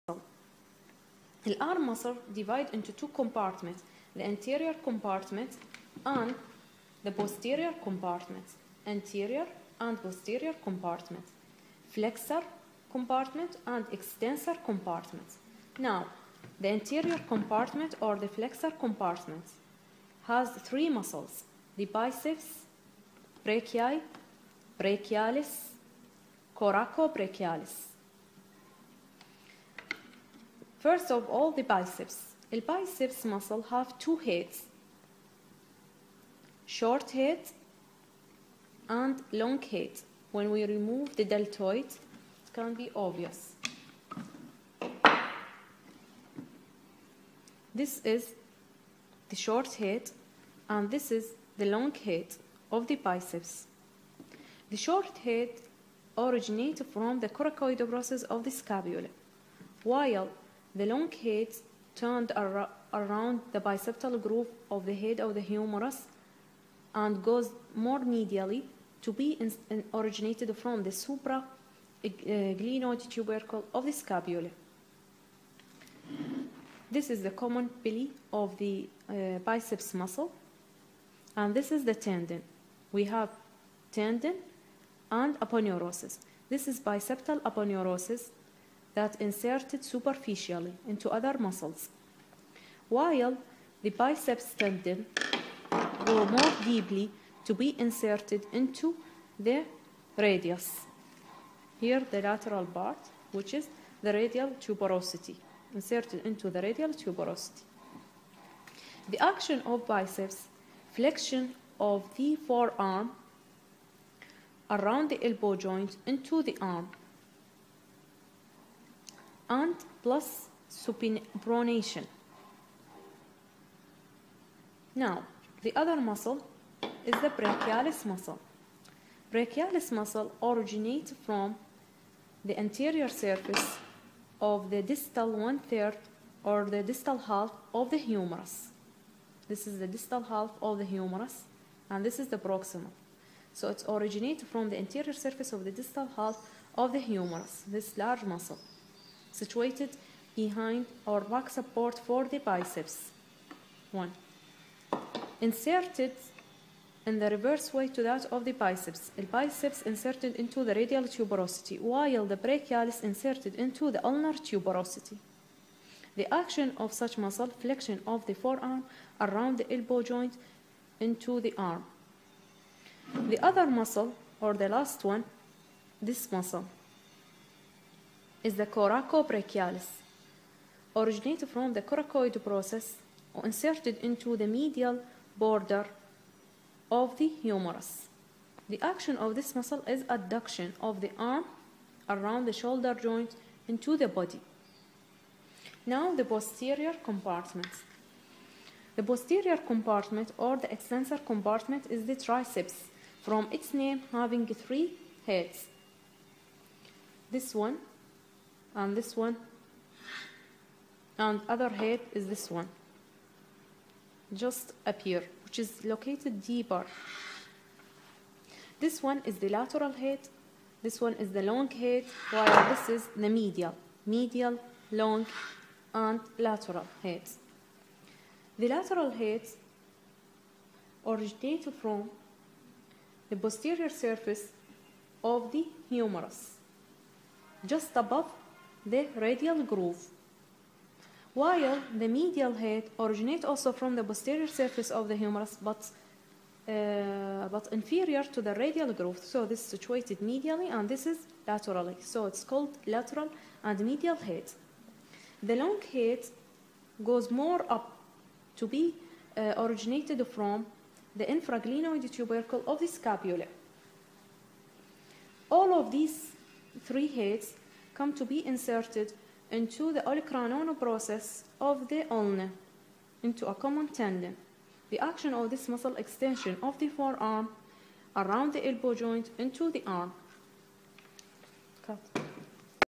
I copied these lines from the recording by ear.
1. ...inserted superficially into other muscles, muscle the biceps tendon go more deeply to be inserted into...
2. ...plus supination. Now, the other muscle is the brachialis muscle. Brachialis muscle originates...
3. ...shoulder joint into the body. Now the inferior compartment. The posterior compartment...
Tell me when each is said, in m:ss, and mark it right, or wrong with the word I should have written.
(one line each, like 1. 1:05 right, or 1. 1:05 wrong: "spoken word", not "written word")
1. 1:29 wrong: "while", not "muscle"
2. 2:00 right
3. 3:12 wrong: "posterior", not "inferior".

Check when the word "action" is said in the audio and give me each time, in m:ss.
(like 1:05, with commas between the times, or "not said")
1:49, 2:46, 3:08, 4:34.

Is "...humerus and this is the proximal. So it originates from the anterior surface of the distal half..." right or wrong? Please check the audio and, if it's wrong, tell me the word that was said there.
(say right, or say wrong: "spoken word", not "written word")
right.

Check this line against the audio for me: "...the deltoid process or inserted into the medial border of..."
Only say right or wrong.
wrong.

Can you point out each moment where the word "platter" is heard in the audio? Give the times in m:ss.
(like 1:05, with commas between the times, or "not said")
not said.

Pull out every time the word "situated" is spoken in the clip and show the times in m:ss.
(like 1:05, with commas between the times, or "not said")
2:29, 4:09.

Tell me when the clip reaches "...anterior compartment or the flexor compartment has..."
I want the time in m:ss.
0:16.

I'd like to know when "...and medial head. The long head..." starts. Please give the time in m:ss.
4:13.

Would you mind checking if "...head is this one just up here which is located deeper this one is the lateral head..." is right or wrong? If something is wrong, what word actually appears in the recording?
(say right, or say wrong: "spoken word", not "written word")
right.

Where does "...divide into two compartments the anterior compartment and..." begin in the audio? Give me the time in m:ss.
0:02.